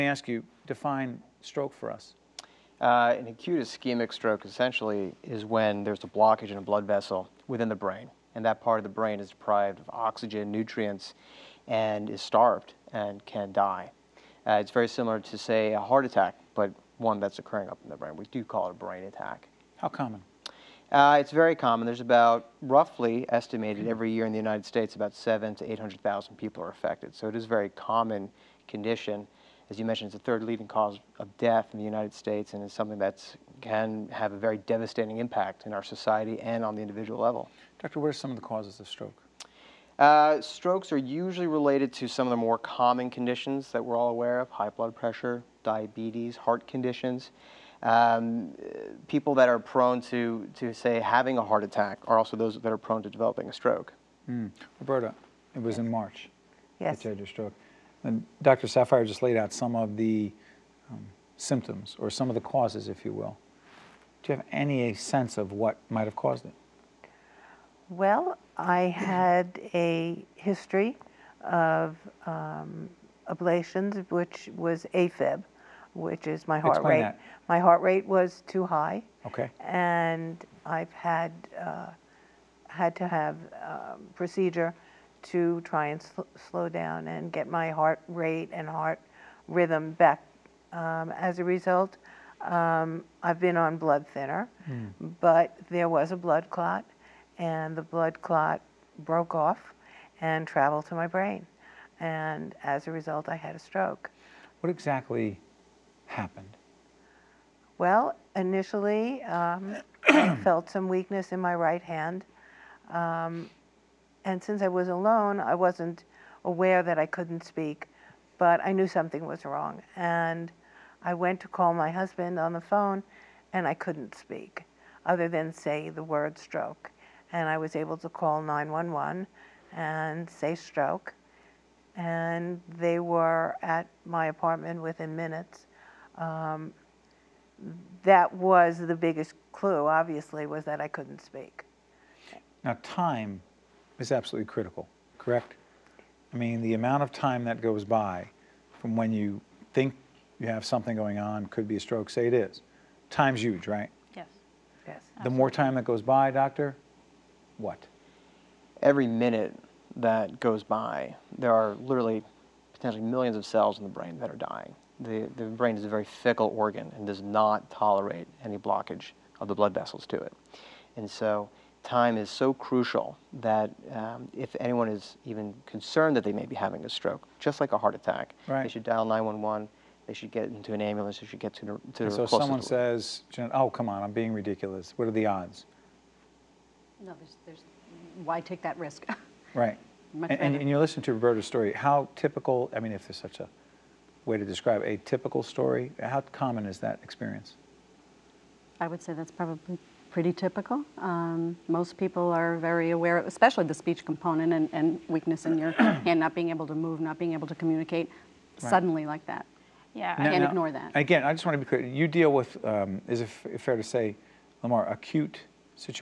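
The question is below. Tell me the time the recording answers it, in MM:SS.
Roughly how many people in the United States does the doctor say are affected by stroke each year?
00:25.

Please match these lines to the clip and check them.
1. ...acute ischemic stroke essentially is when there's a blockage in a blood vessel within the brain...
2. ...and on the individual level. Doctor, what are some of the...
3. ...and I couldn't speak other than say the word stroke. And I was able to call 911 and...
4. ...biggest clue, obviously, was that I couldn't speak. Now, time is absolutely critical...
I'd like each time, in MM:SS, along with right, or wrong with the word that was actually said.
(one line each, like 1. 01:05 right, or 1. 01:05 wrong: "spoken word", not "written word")
1. 00:03 right
2. 00:36 right
3. 02:03 right
4. 02:18 right.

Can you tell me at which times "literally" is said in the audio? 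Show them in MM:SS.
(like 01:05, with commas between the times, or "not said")
02:41.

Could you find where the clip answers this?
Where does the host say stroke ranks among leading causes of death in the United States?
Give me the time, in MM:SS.
00:30.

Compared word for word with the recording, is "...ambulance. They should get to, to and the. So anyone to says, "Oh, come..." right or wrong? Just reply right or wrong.
wrong.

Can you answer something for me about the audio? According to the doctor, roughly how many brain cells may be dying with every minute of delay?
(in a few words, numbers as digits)
millions.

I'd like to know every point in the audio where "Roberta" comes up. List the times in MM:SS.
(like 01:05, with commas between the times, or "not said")
00:54, 03:11.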